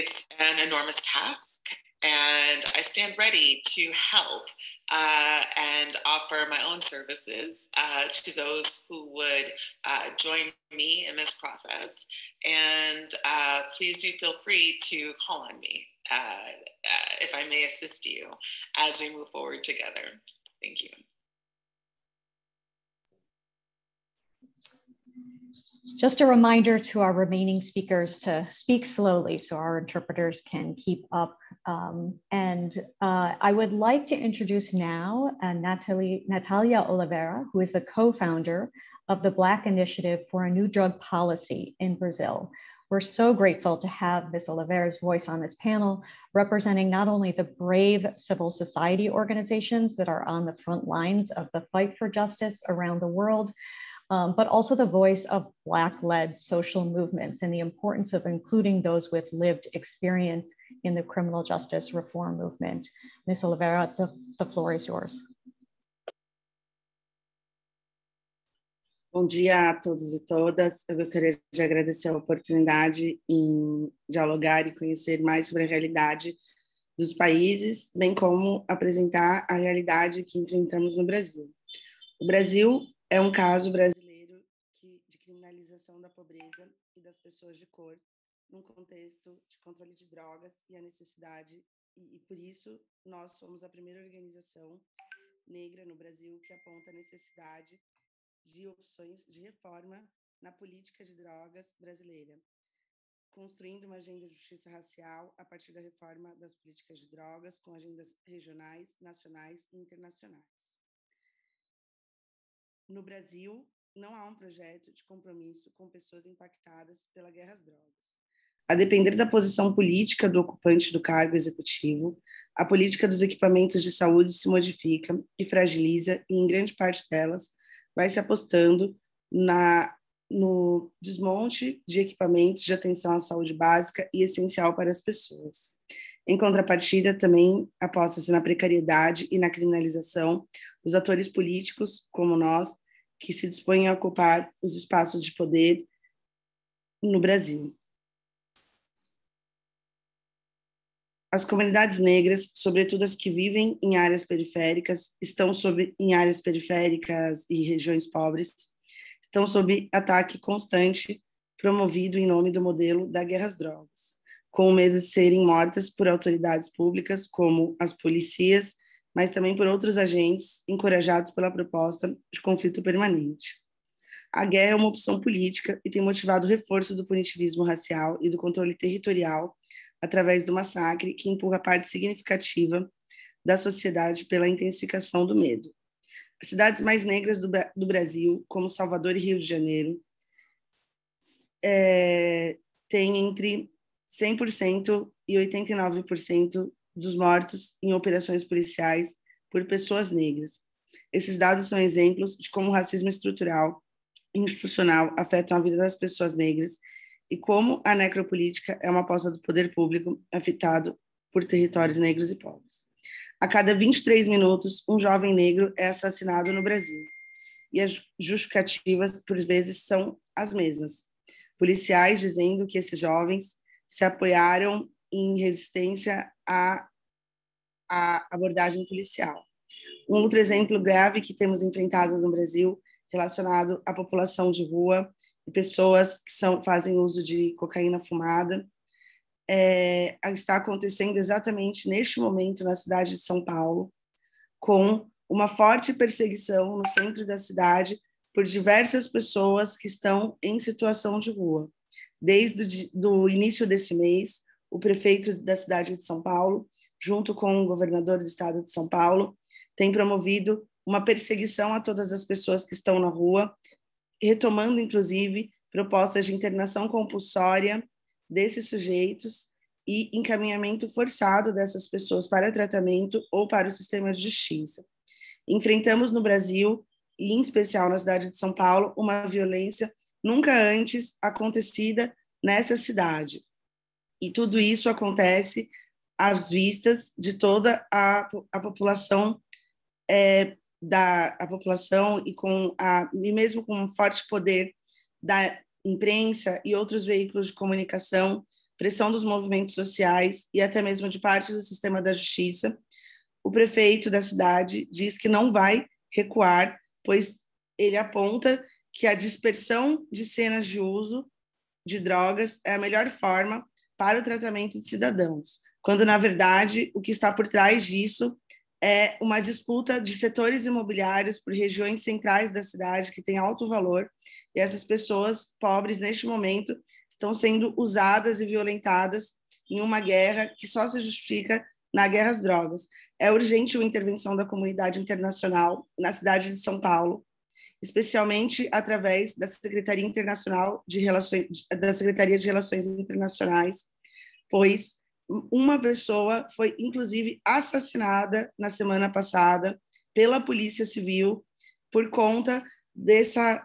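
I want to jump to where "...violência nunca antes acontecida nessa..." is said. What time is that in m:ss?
4:39.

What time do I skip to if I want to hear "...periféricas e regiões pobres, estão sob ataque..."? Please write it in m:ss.
2:36.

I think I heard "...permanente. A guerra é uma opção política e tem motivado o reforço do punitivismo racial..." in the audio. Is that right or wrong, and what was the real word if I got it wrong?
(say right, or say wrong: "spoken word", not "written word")
right.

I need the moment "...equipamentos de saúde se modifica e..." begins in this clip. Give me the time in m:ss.
2:03.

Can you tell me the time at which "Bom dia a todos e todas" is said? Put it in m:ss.
1:09.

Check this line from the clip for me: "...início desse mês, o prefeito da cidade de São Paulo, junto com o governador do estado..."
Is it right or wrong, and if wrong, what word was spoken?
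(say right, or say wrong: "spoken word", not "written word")
right.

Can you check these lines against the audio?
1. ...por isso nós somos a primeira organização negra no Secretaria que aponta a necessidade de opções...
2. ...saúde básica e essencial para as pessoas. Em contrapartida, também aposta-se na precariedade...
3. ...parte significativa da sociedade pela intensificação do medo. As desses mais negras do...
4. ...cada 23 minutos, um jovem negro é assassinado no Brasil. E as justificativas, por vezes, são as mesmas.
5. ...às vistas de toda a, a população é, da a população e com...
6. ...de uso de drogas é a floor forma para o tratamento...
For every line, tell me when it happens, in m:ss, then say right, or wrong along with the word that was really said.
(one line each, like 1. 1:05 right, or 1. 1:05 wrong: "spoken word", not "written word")
1. 1:32 wrong: "Brasil", not "Secretaria"
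2. 2:13 right
3. 3:01 wrong: "cidades", not "desses"
4. 3:33 right
5. 4:46 right
6. 5:10 wrong: "melhor", not "floor".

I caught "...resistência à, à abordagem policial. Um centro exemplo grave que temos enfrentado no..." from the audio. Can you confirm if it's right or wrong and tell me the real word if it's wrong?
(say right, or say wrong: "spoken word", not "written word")
wrong: "outro", not "centro".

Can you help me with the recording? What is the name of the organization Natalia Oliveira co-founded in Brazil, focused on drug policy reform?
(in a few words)
Black Initiative for a New Drug Policy.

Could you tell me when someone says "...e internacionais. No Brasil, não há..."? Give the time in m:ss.
1:49.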